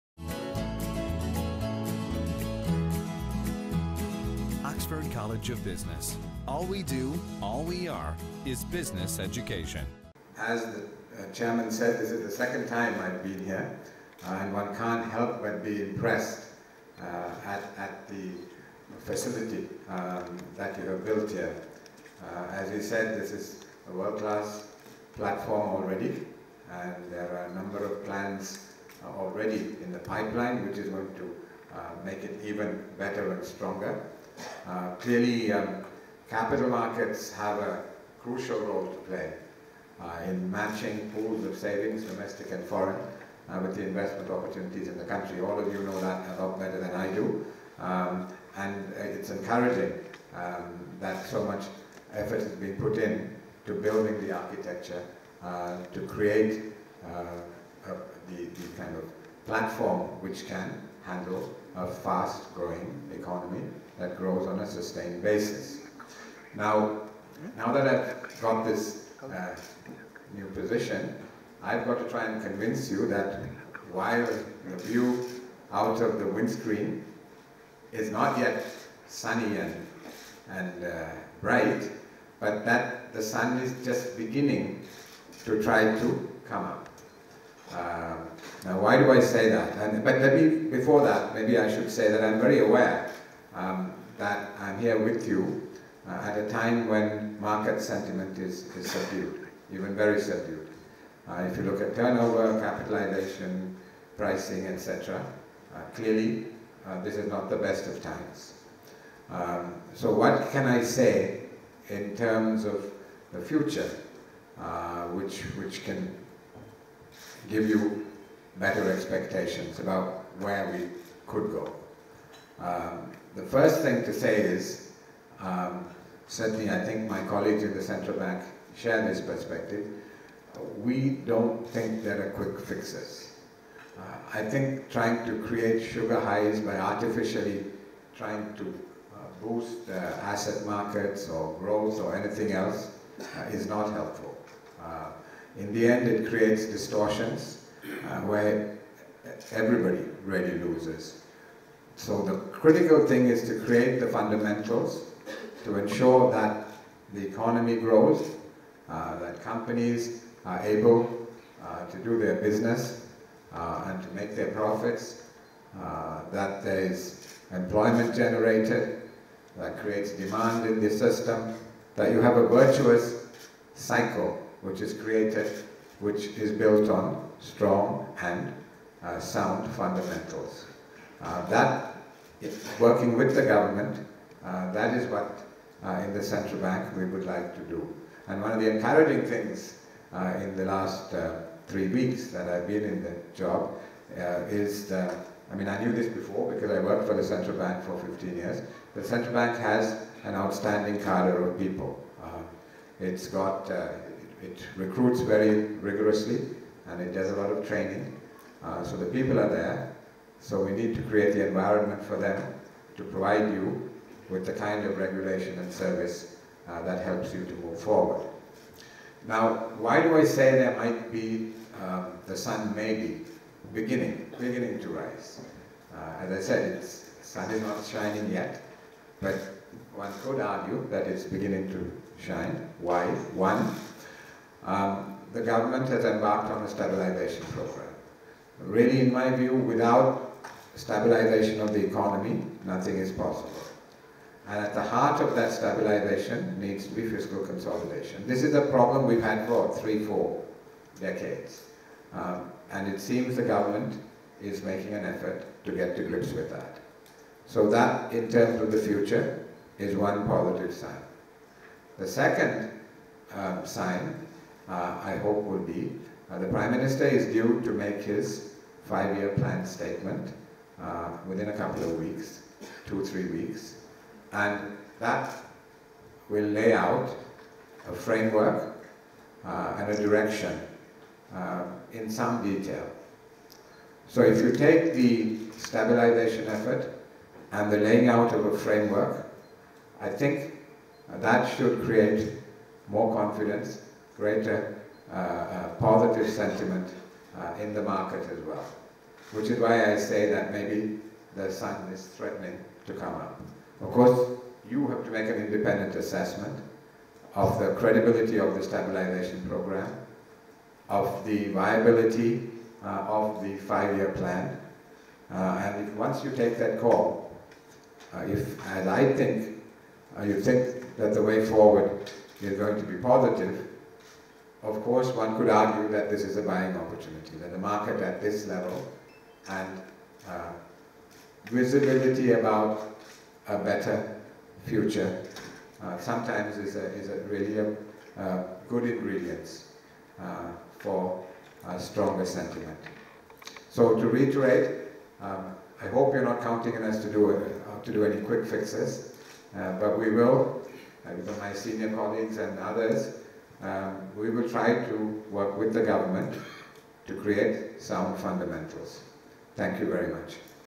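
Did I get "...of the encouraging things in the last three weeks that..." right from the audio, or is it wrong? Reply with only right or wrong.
right.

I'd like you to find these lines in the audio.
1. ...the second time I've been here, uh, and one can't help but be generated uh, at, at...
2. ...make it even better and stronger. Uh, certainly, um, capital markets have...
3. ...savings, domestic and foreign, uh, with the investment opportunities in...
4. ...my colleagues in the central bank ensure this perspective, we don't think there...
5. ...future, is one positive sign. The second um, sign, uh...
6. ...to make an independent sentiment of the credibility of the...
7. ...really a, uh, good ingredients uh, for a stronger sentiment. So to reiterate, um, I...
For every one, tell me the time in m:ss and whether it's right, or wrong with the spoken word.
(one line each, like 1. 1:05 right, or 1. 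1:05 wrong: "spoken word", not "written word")
1. 0:12 wrong: "impressed", not "generated"
2. 0:32 wrong: "clearly", not "certainly"
3. 0:41 right
4. 2:07 wrong: "share", not "ensure"
5. 4:18 right
6. 5:05 wrong: "assessment", not "sentiment"
7. 5:37 right.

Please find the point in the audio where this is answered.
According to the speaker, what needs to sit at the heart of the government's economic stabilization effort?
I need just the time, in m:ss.
4:07.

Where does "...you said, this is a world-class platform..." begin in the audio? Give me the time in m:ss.
0:22.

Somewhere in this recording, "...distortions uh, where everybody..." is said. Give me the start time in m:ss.
2:26.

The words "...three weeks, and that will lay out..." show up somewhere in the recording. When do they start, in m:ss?
4:33.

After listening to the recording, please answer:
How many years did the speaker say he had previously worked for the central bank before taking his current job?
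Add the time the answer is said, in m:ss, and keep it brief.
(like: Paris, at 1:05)
15, at 3:17.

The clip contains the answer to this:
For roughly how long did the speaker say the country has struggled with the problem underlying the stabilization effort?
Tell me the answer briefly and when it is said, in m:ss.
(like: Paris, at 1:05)
three, four decades, at 4:09.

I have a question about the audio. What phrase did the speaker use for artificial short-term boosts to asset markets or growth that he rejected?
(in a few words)
sugar highs.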